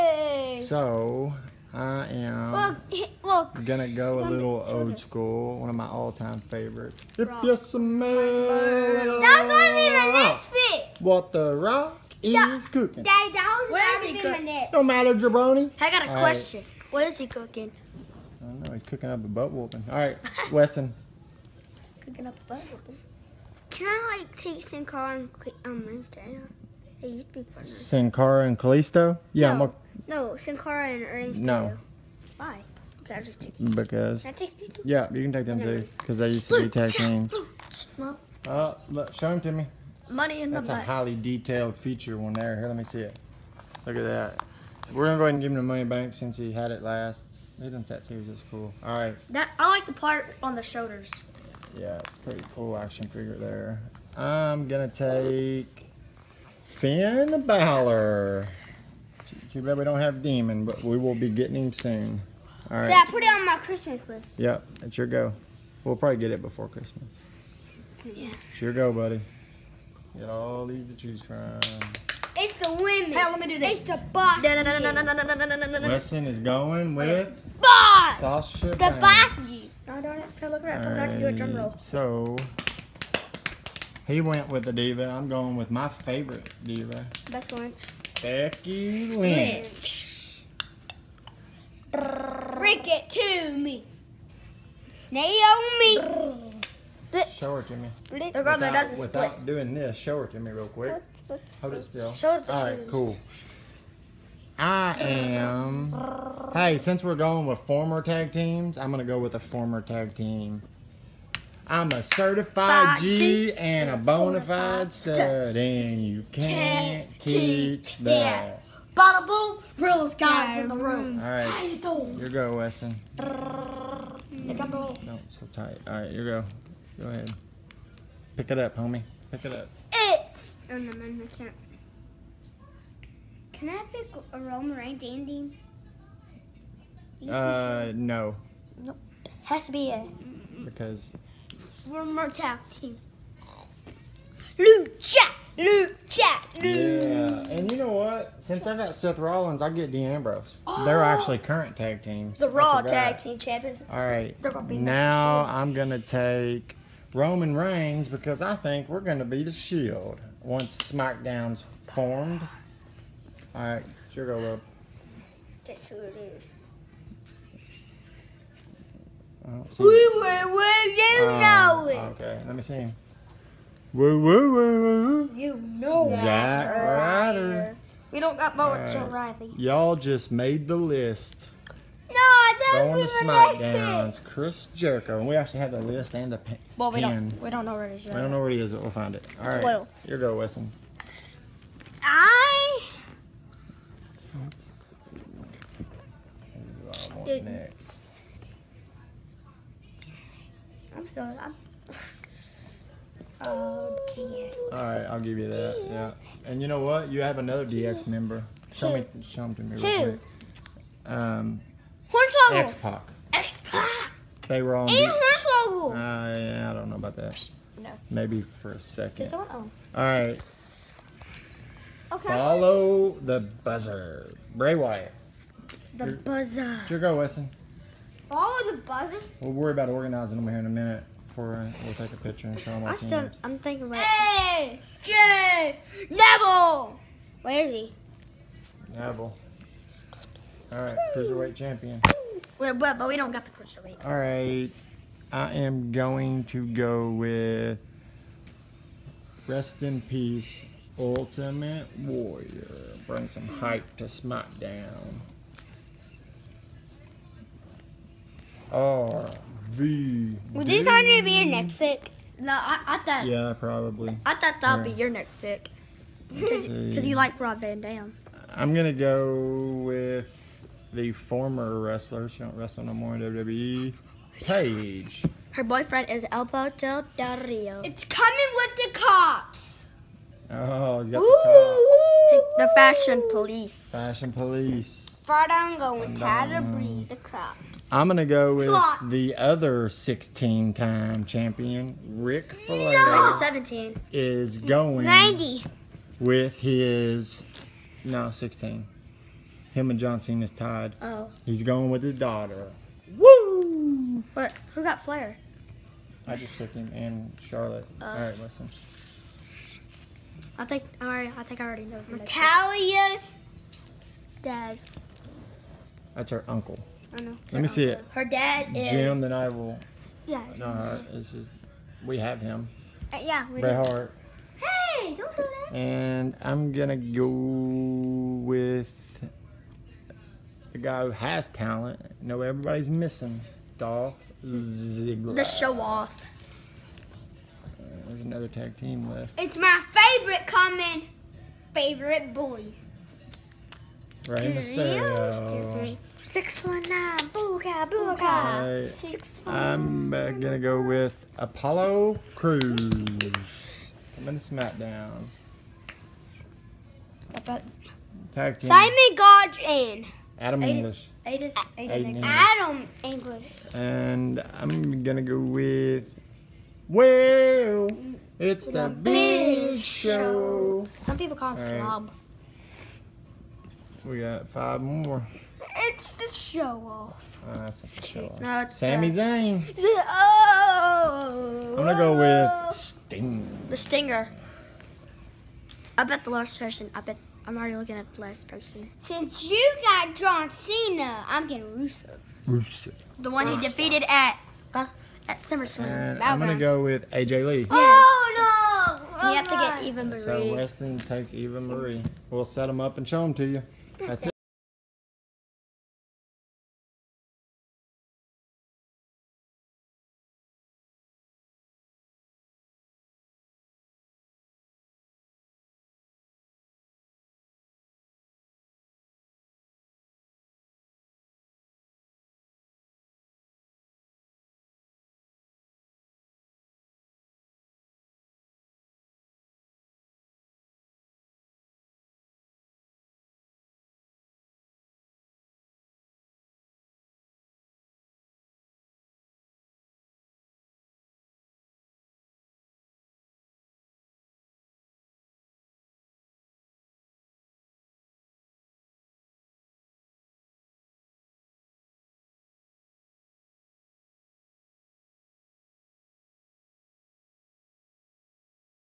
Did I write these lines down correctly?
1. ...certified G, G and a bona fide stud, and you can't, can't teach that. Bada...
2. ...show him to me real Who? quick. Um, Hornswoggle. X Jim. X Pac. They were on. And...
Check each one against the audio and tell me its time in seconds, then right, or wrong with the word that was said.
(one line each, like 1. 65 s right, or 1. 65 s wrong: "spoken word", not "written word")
1. 112 s right
2. 209 s wrong: "Pac", not "Jim".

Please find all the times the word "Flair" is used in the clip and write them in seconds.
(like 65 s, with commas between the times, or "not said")
292 s, 305 s.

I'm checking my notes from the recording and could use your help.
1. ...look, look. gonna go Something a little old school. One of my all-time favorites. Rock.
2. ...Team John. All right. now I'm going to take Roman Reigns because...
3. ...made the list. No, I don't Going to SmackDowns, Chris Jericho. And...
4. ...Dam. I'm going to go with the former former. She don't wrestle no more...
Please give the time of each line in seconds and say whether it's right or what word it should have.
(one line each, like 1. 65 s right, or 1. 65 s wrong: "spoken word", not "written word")
1. 2 s right
2. 153 s wrong: "Champions", not "John"
3. 180 s right
4. 267 s wrong: "wrestler", not "former".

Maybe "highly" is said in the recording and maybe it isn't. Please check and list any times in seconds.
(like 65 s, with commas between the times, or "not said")
40 s.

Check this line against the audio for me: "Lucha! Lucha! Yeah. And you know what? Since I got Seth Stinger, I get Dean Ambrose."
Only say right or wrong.
wrong.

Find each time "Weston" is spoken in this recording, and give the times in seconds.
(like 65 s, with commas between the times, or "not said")
20 s, 122 s, 190 s, 227 s, 400 s.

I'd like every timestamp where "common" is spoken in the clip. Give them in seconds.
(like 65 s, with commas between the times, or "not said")
340 s.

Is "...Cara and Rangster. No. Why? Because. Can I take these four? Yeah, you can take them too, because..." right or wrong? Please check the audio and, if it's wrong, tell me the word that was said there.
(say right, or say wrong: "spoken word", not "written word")
wrong: "two", not "four".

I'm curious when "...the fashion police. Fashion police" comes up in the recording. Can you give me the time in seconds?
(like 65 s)
282 s.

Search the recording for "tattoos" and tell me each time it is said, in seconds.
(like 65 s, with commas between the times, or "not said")
47 s.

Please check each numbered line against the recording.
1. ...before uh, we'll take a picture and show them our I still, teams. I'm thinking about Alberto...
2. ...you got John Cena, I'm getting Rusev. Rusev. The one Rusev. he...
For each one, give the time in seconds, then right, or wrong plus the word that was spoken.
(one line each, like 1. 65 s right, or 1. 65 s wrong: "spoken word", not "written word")
1. 231 s wrong: "Hey", not "Alberto"
2. 389 s right.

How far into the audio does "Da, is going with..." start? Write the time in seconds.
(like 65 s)
74 s.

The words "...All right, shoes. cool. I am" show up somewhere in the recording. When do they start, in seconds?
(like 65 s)
102 s.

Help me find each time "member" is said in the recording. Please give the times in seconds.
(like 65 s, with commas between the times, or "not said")
208 s.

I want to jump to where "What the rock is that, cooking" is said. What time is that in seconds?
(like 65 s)
11 s.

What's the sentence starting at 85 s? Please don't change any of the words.
I'm going with my favorite diva.